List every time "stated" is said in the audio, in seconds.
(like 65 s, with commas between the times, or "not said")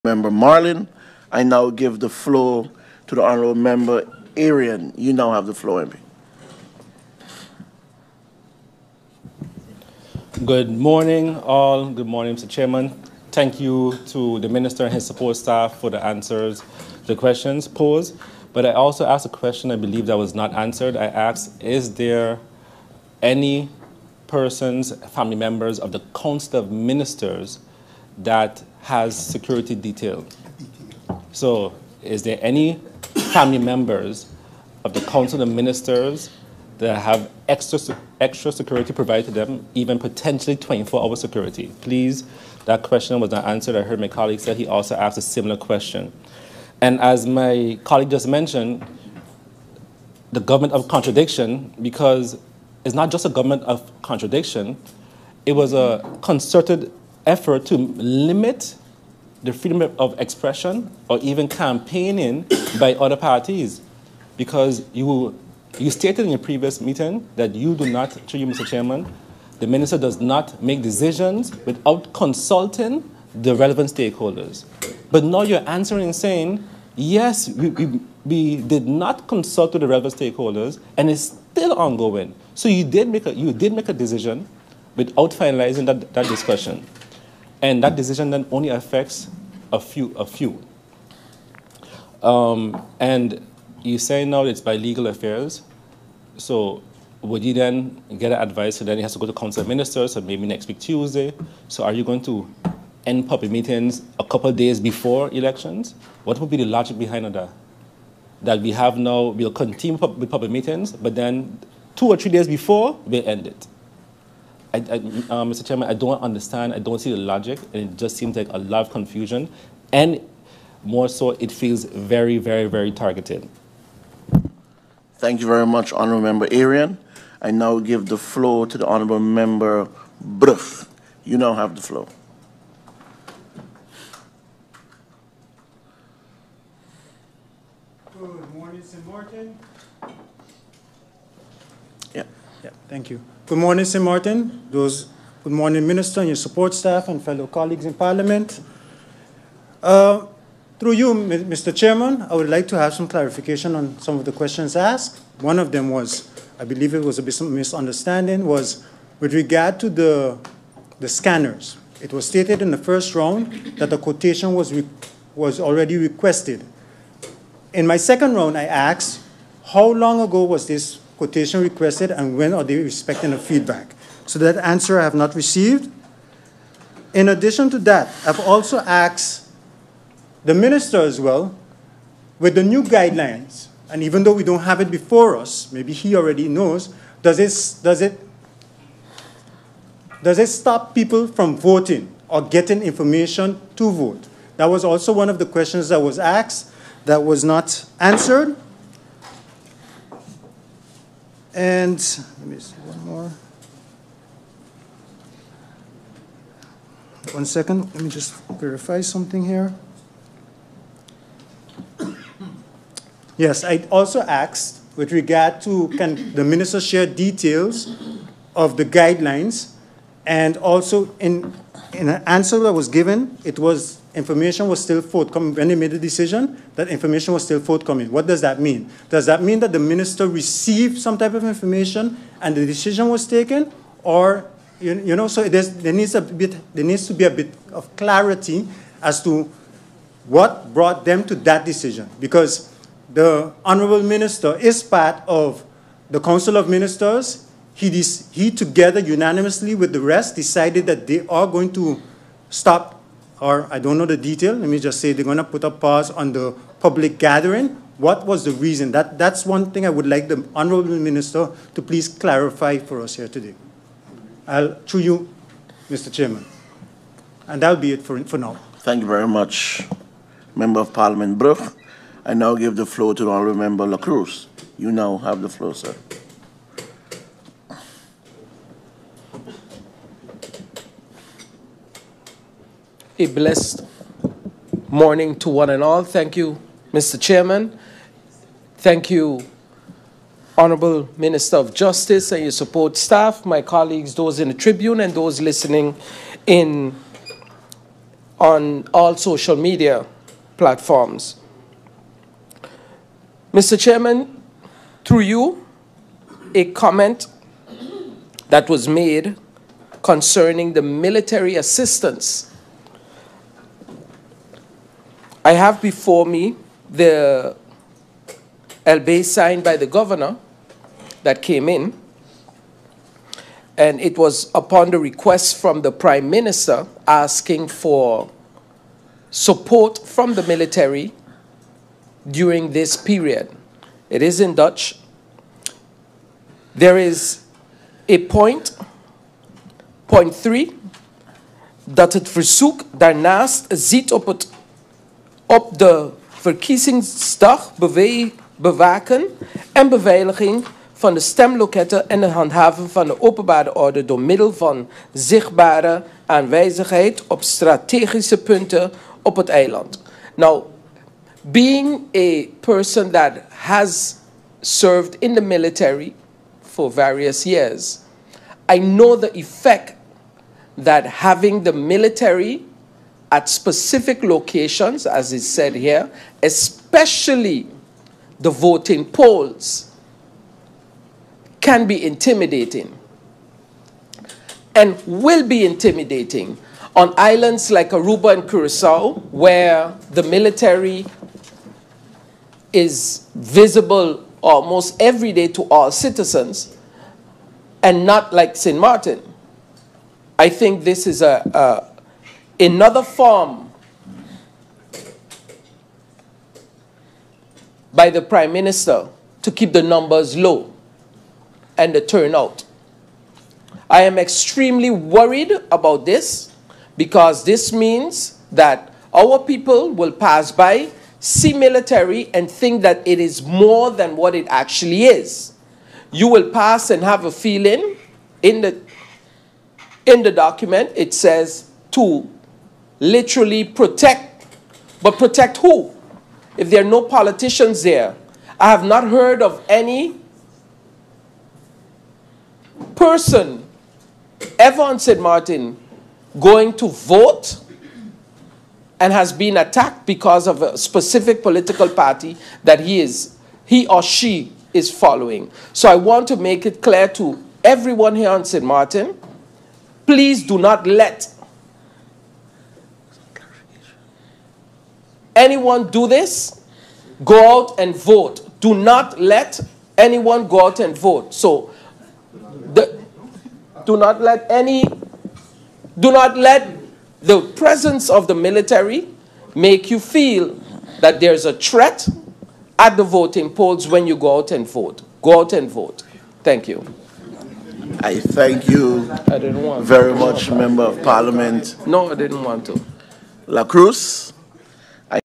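65 s, 162 s.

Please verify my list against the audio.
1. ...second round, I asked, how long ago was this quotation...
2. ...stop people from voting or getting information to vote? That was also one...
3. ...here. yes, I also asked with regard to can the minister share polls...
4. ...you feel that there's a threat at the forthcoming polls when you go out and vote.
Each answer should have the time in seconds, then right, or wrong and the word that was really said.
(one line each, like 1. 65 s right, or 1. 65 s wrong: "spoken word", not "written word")
1. 167 s right
2. 190 s right
3. 209 s wrong: "details", not "polls"
4. 479 s wrong: "voting", not "forthcoming".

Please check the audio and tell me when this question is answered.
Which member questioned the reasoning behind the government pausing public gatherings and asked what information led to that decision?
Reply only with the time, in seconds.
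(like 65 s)
130 s.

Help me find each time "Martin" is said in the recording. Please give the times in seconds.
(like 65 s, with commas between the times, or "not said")
139 s, 144 s, 398 s, 445 s, 458 s.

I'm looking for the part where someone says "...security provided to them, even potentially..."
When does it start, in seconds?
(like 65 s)
38 s.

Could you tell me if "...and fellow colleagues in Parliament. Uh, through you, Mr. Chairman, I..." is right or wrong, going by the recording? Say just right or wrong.
right.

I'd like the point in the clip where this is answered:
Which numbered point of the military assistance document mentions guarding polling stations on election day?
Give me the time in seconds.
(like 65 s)
340 s.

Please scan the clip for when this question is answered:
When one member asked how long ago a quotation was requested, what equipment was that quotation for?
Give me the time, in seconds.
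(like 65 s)
161 s.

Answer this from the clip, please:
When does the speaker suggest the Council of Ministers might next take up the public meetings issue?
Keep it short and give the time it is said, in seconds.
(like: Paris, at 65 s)
Next week Tuesday, at 100 s.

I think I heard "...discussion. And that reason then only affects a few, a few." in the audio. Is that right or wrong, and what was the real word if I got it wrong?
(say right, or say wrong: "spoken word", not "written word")
wrong: "decision", not "reason".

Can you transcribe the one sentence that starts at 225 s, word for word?
When they made the decision, that information was still forthcoming.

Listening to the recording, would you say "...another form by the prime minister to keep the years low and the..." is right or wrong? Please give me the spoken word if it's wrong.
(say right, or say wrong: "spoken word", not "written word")
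wrong: "numbers", not "years".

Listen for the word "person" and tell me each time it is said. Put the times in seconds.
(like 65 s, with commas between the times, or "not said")
24 s, 362 s, 442 s.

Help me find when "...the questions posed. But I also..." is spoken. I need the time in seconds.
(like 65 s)
17 s.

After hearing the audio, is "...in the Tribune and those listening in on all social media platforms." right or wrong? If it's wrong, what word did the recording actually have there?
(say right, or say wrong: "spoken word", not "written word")
right.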